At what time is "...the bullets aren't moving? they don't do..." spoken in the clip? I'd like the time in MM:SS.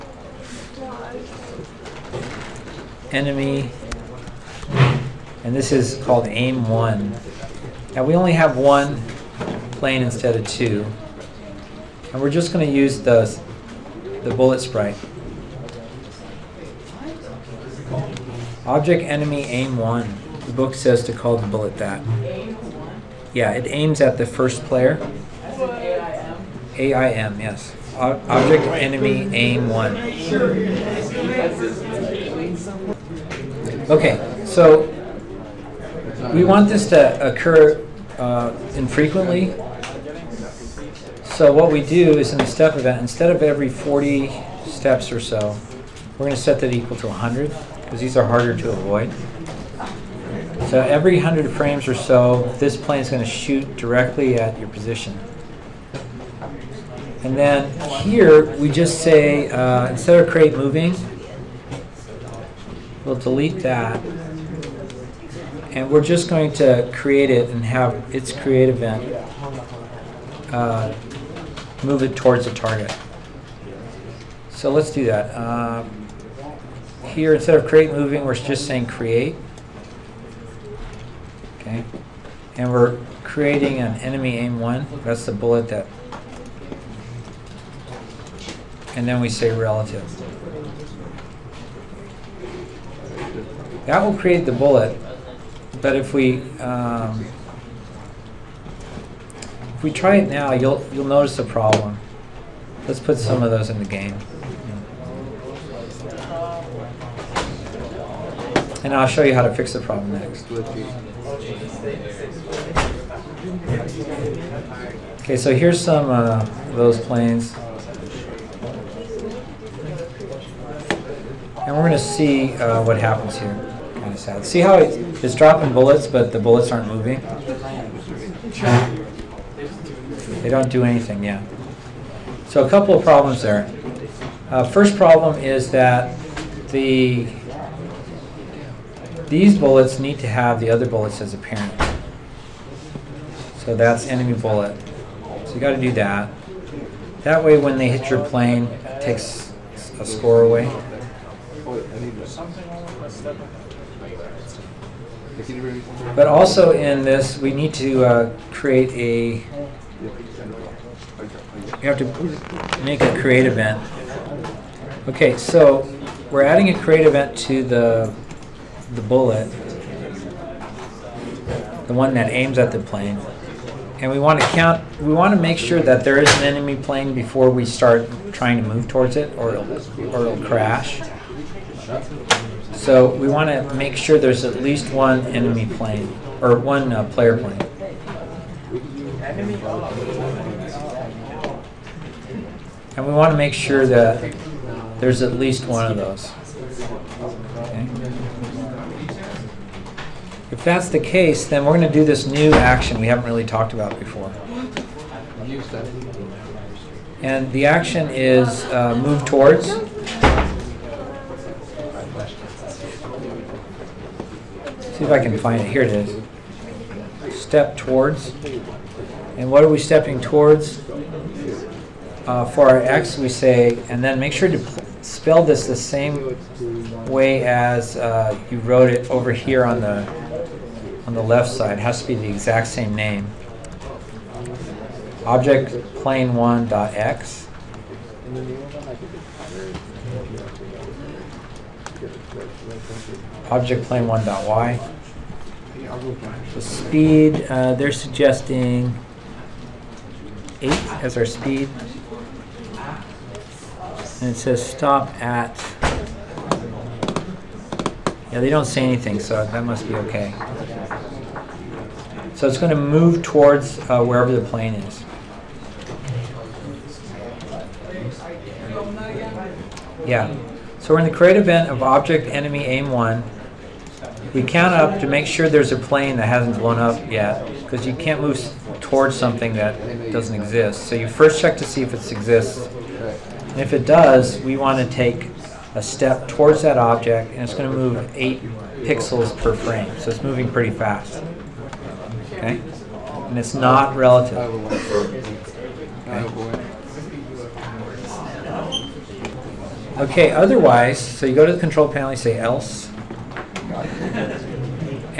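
02:06.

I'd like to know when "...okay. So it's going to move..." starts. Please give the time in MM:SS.
04:19.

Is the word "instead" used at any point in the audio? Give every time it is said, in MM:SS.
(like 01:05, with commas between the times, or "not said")
00:10, 00:43, 00:59, 01:17.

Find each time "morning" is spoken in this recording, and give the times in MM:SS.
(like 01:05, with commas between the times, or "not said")
not said.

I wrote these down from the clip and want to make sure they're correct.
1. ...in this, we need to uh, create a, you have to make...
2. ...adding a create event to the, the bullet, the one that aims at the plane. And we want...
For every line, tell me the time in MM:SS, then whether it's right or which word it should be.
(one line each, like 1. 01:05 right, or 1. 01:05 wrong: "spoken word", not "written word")
1. 02:36 right
2. 02:46 right.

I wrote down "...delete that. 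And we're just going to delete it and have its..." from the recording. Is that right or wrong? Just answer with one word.
wrong.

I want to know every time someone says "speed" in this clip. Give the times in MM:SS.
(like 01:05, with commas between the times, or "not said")
04:06, 04:11.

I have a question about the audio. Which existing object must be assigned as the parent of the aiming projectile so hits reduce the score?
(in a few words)
enemy bullet.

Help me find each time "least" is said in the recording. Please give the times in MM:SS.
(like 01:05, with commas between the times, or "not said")
03:04, 03:15.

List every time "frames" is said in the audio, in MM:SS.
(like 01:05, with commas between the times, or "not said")
00:51, 04:49.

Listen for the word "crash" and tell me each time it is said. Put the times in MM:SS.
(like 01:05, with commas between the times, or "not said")
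03:00.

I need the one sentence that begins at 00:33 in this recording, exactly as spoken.
Okay, so we want this to occur uh, infrequently.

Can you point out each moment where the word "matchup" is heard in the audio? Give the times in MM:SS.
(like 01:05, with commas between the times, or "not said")
not said.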